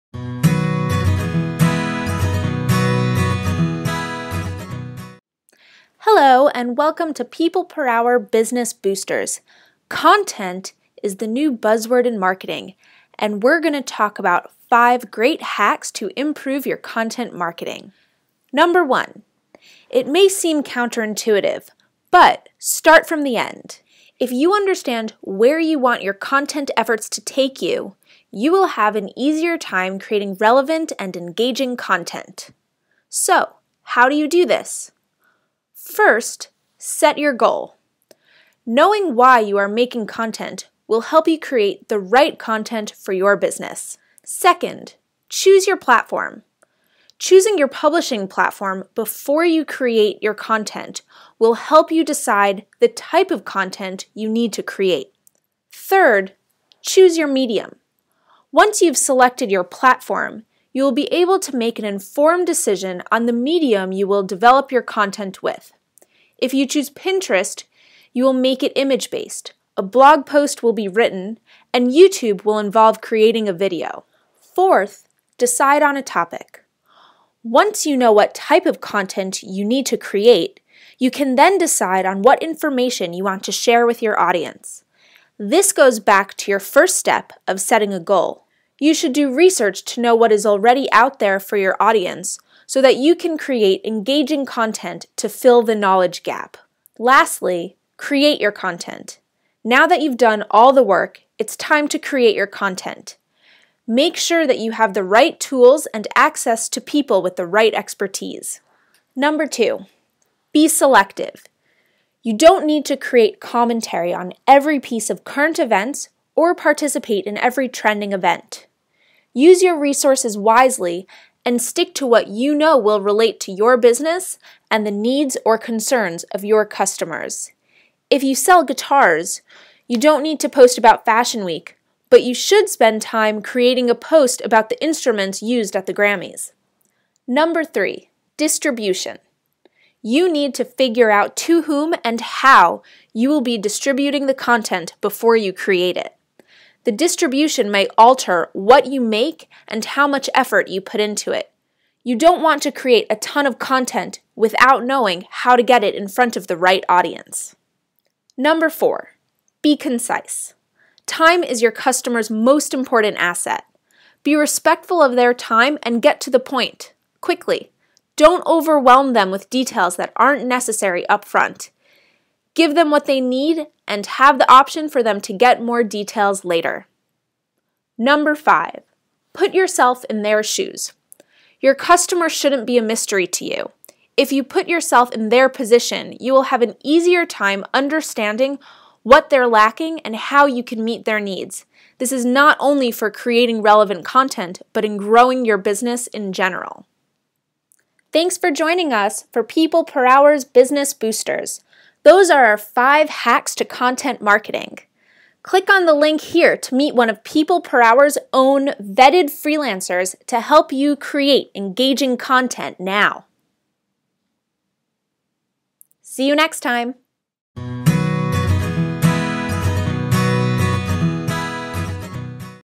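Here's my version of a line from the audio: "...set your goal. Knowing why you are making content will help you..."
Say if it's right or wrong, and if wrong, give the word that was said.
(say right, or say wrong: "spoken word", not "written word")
right.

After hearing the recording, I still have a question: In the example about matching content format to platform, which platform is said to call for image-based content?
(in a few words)
Pinterest.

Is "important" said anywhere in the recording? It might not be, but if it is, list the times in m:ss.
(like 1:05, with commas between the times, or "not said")
2:42.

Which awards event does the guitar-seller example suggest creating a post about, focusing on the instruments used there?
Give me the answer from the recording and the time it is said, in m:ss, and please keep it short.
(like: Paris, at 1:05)
the Grammys, at 2:15.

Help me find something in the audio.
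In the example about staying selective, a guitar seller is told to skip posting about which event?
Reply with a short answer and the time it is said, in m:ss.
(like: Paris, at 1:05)
Fashion Week, at 2:11.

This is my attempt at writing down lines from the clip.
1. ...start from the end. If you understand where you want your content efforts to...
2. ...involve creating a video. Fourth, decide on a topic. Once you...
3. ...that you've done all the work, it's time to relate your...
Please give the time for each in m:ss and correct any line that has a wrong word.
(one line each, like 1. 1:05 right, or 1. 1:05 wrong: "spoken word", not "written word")
1. 0:22 right
2. 1:12 right
3. 1:39 wrong: "create", not "relate".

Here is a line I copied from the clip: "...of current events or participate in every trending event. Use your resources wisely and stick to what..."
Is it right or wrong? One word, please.
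right.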